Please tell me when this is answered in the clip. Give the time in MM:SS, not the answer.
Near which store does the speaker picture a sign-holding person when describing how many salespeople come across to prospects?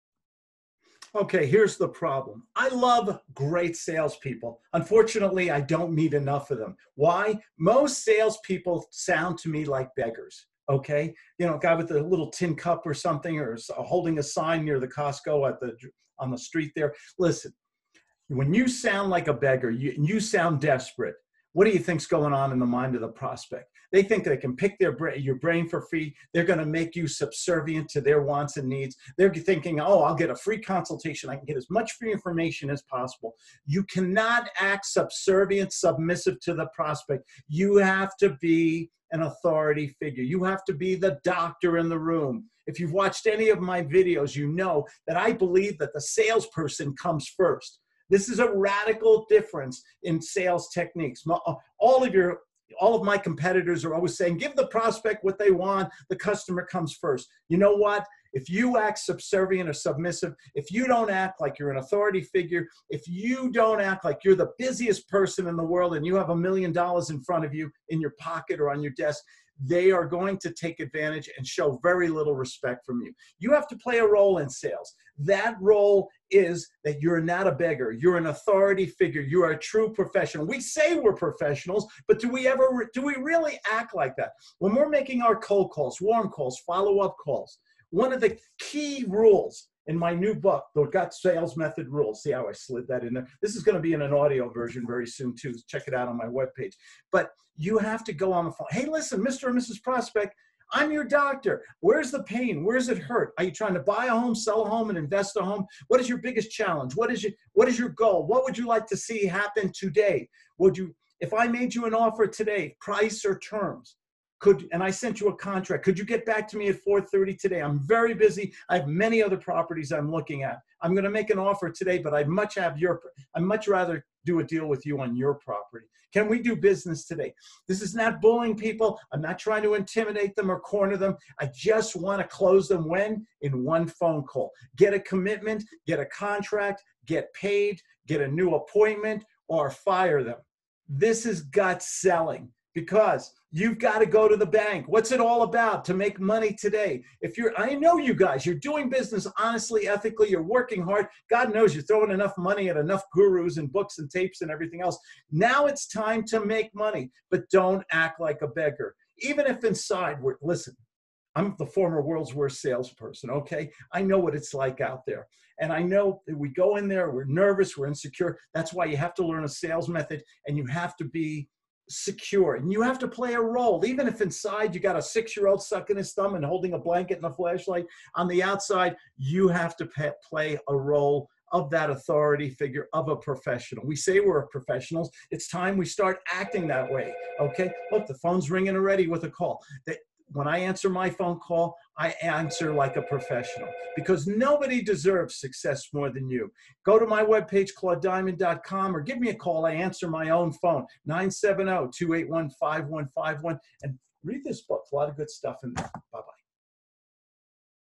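00:14.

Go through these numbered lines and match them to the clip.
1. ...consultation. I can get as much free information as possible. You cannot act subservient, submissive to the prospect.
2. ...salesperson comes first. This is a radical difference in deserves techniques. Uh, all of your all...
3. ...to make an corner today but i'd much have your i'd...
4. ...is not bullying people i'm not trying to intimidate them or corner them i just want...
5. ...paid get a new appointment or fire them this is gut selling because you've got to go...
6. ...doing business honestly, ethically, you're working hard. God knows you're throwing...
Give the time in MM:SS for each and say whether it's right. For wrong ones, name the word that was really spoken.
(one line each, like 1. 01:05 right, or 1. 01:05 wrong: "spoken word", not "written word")
1. 00:30 right
2. 00:45 wrong: "sales", not "deserves"
3. 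02:01 wrong: "offer", not "corner"
4. 02:07 right
5. 02:17 right
6. 02:28 right.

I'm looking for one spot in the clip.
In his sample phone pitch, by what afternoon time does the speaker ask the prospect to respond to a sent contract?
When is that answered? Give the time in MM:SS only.
01:56.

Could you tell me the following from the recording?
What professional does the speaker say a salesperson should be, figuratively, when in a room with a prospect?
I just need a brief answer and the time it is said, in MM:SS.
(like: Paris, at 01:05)
the doctor, at 00:40.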